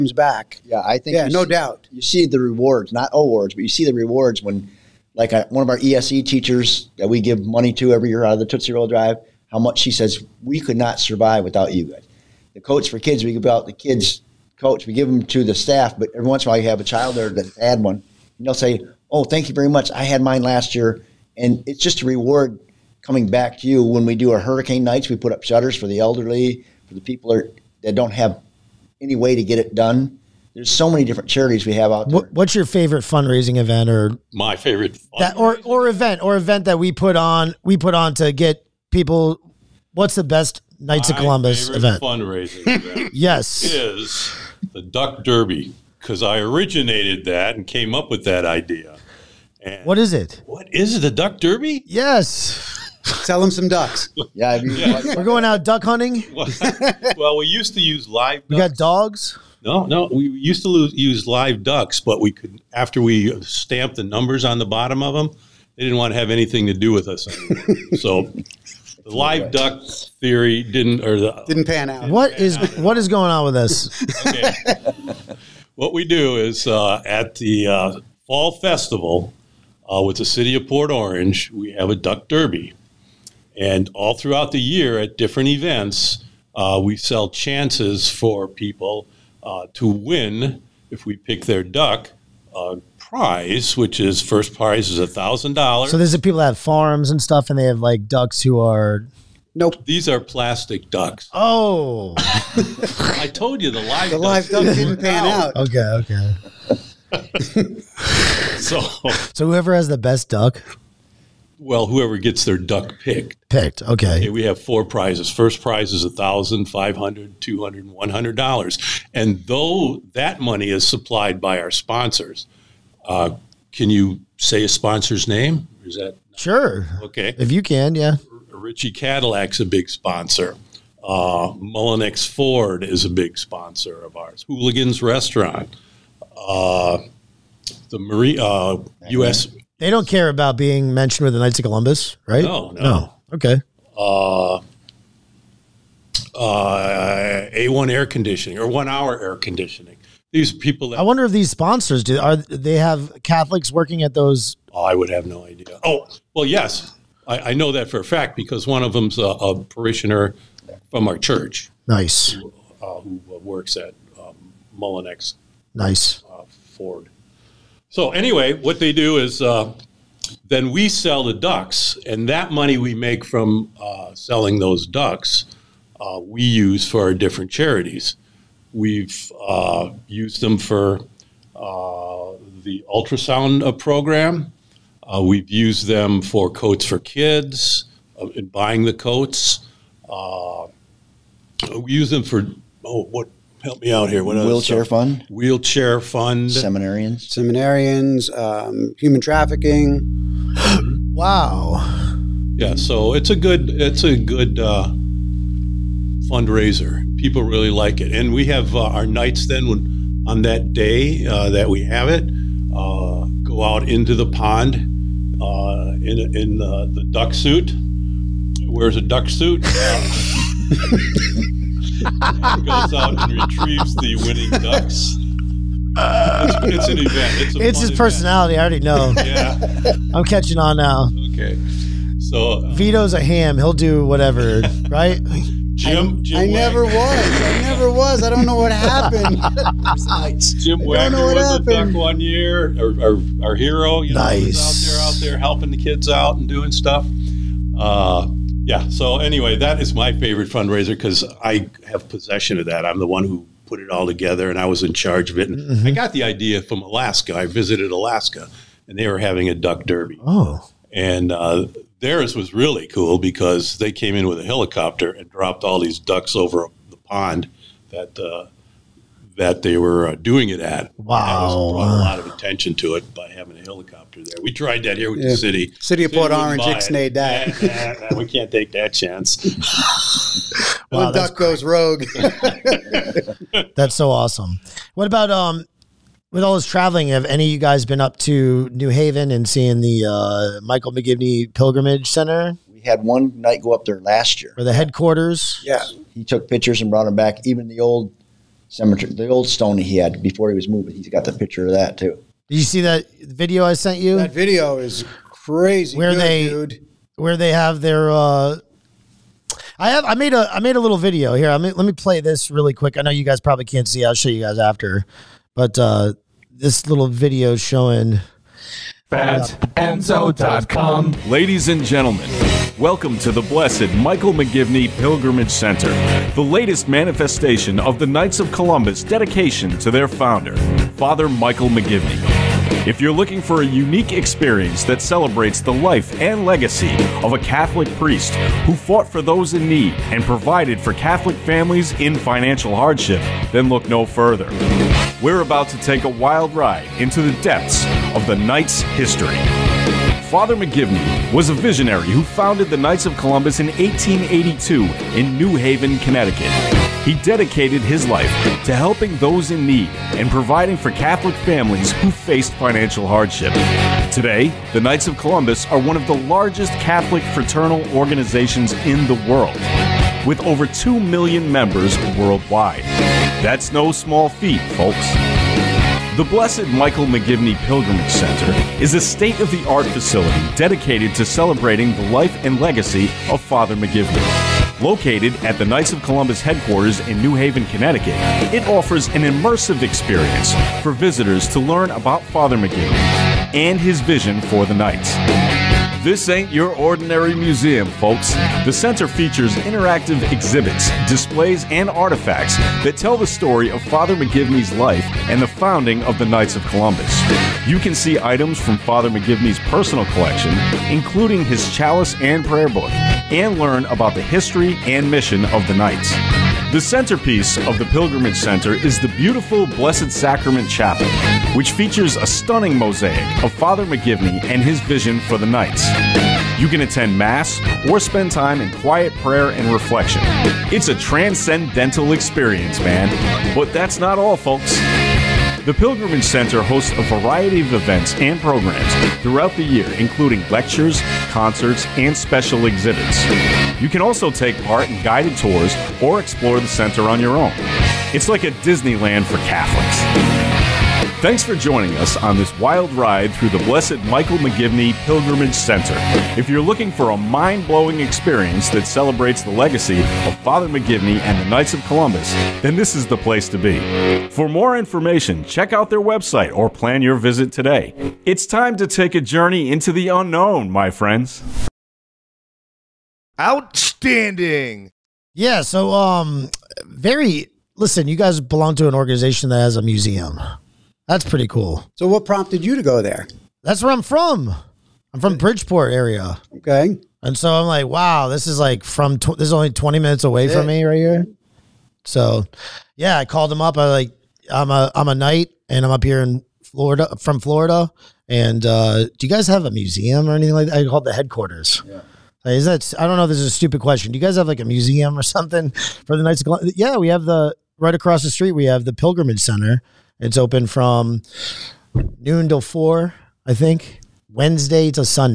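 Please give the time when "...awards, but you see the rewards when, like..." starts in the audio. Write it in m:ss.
0:03.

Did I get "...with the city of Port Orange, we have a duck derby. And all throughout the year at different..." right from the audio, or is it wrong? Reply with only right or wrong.
right.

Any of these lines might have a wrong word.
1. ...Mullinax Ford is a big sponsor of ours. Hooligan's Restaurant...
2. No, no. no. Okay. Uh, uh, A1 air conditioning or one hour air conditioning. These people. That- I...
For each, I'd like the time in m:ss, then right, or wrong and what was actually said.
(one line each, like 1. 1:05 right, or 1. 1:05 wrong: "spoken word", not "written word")
1. 2:11 right
2. 2:22 right.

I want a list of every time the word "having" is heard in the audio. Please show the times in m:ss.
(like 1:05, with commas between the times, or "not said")
4:19, 4:33.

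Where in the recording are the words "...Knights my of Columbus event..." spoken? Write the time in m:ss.
0:40.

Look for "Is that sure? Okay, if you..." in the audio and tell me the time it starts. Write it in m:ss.
2:05.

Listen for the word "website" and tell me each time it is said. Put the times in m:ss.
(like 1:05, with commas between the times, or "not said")
7:46.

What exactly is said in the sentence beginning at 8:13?
I like, I'm a, I'm a knight and I'm up here in Florida, from Florida.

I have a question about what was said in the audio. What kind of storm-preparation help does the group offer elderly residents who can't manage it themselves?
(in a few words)
put up shutters.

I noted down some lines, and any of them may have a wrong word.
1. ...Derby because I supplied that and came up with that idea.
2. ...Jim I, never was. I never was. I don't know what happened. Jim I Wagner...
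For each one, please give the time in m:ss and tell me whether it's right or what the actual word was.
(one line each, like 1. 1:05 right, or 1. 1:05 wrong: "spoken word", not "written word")
1. 0:45 wrong: "originated", not "supplied"
2. 3:56 right.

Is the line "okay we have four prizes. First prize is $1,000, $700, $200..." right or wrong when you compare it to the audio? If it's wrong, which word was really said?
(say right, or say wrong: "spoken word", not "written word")
wrong: "500", not "700".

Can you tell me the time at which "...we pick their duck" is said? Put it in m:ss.
1:31.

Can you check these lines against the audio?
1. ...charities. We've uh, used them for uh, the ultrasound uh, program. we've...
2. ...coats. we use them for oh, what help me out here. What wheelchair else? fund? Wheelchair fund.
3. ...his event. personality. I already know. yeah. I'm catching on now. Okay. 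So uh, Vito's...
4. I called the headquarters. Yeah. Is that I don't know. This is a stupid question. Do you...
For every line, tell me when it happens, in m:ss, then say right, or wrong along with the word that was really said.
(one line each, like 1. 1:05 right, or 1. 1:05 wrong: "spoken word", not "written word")
1. 2:57 right
2. 3:08 right
3. 3:47 right
4. 8:20 right.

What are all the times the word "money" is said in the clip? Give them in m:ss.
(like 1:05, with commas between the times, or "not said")
0:07, 2:00, 2:52.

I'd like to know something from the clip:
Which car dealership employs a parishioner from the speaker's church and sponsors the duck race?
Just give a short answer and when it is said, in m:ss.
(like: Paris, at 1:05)
Mullinax Ford, at 2:44.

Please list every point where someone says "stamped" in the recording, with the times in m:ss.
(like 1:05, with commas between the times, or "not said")
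1:03.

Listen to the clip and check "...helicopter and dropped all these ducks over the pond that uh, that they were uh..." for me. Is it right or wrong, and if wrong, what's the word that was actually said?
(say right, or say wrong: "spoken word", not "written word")
right.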